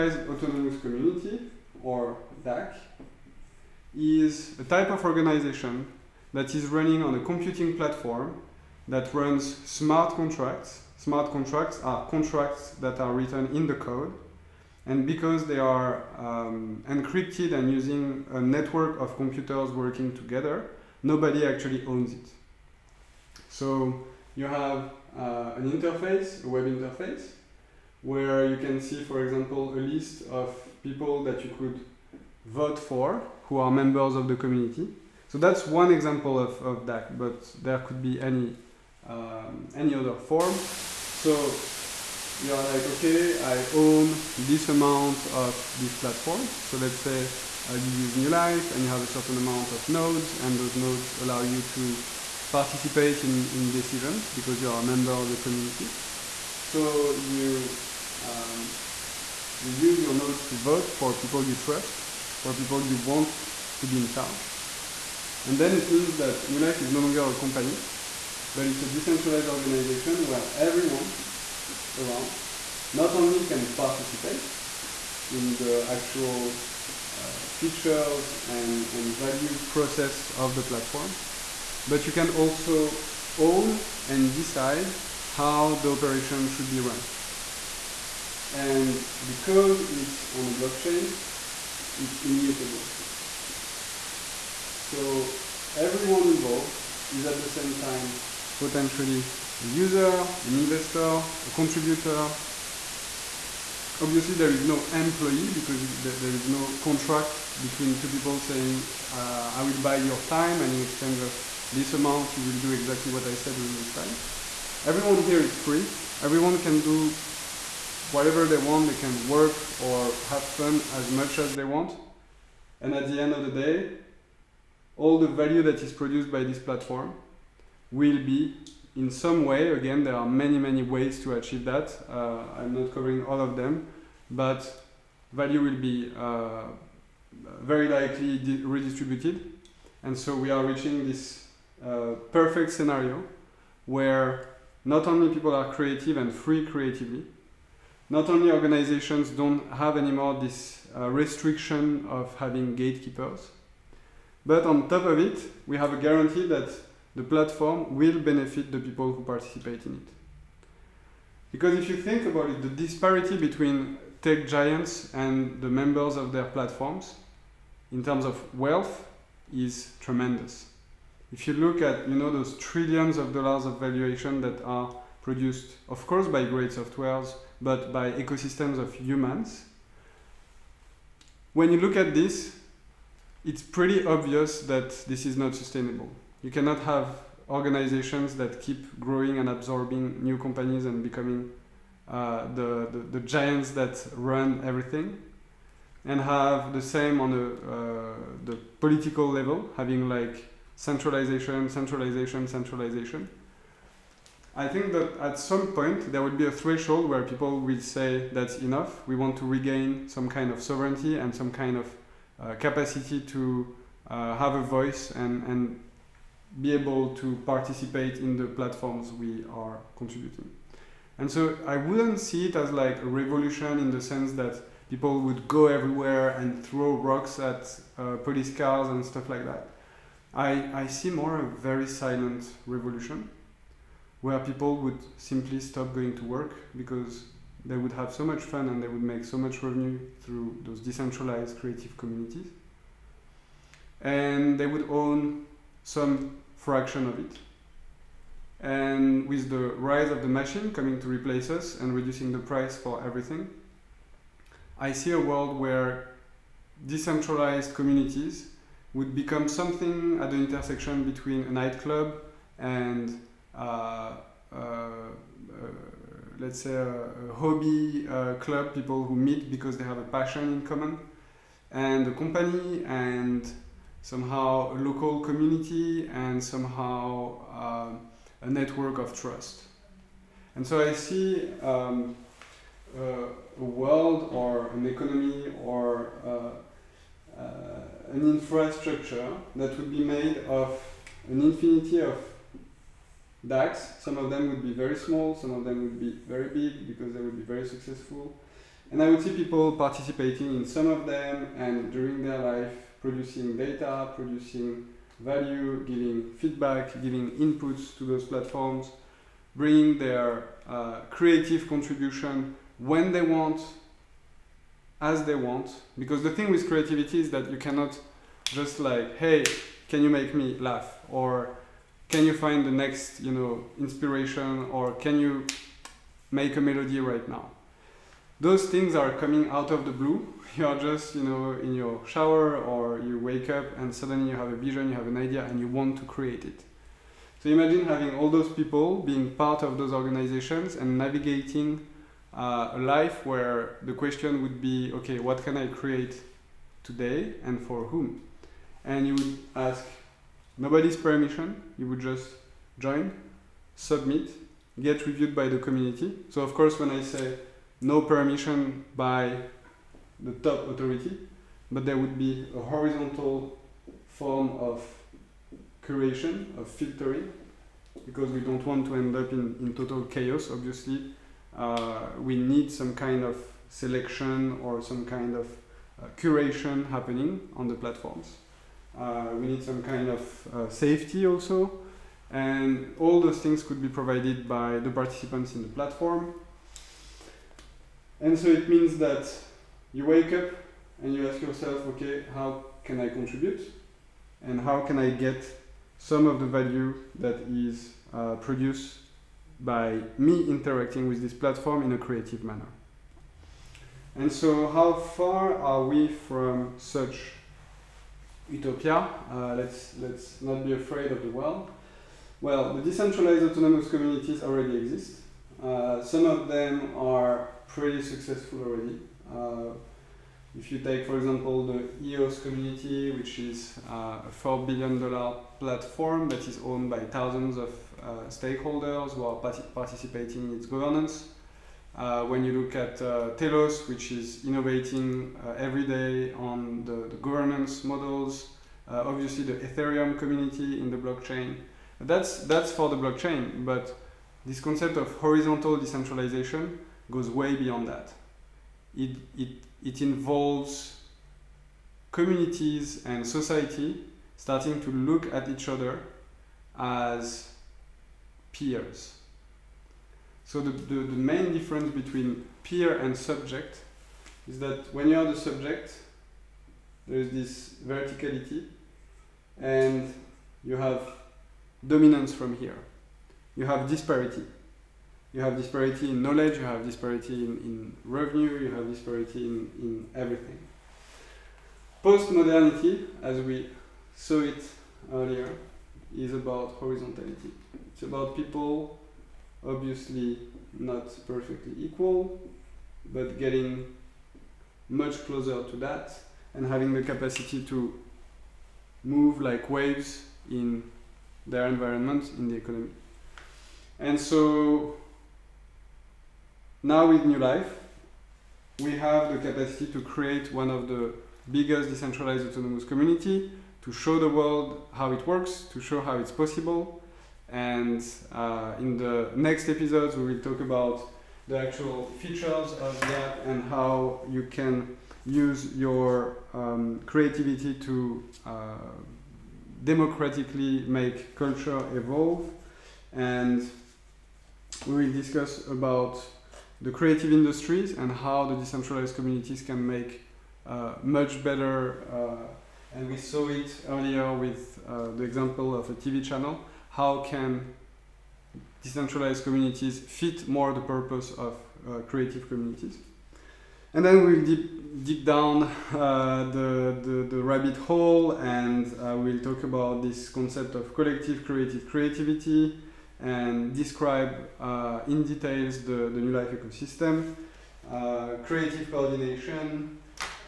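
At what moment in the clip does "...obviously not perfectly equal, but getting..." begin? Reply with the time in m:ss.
8:09.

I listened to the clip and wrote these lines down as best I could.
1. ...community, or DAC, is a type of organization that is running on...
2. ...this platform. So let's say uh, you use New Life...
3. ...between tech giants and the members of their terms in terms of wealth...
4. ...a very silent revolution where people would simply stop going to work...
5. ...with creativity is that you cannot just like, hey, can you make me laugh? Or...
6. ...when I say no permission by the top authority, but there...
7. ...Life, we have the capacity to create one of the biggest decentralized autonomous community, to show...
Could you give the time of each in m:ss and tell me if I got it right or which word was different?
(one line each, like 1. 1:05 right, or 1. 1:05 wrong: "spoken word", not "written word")
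1. 0:00 right
2. 0:45 right
3. 2:43 wrong: "platforms", not "terms"
4. 3:51 right
5. 5:16 right
6. 5:56 right
7. 8:27 right.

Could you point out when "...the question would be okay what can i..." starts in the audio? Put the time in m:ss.
5:43.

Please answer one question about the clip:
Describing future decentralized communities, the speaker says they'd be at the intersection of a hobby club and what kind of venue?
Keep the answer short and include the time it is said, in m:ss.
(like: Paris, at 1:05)
a nightclub, at 4:21.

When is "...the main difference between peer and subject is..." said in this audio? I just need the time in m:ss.
7:40.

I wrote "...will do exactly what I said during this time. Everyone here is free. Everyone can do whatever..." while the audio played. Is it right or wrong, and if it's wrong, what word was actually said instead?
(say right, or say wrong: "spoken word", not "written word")
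right.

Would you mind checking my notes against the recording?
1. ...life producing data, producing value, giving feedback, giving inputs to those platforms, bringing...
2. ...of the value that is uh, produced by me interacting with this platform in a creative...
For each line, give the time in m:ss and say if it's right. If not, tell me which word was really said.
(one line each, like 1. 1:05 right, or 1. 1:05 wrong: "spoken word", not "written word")
1. 5:02 right
2. 6:36 right.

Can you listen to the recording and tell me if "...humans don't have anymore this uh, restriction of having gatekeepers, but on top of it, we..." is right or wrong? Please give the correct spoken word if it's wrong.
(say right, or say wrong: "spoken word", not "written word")
wrong: "organizations", not "humans".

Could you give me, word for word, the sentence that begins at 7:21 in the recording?
That's, that's for the blockchain, but this concept of horizontal decentralization goes way beyond that.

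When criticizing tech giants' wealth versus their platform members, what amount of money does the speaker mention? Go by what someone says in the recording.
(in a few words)
trillions of dollars.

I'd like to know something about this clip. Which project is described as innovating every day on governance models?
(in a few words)
Telos.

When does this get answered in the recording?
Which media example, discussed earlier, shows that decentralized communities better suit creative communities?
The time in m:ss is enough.
9:05.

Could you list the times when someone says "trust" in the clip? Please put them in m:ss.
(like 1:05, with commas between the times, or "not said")
1:01, 4:39.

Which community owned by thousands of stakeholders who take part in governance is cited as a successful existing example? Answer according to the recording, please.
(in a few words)
EOS.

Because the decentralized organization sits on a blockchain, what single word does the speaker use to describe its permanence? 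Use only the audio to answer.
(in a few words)
immutable.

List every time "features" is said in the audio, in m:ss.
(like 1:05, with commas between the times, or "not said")
1:17, 8:42.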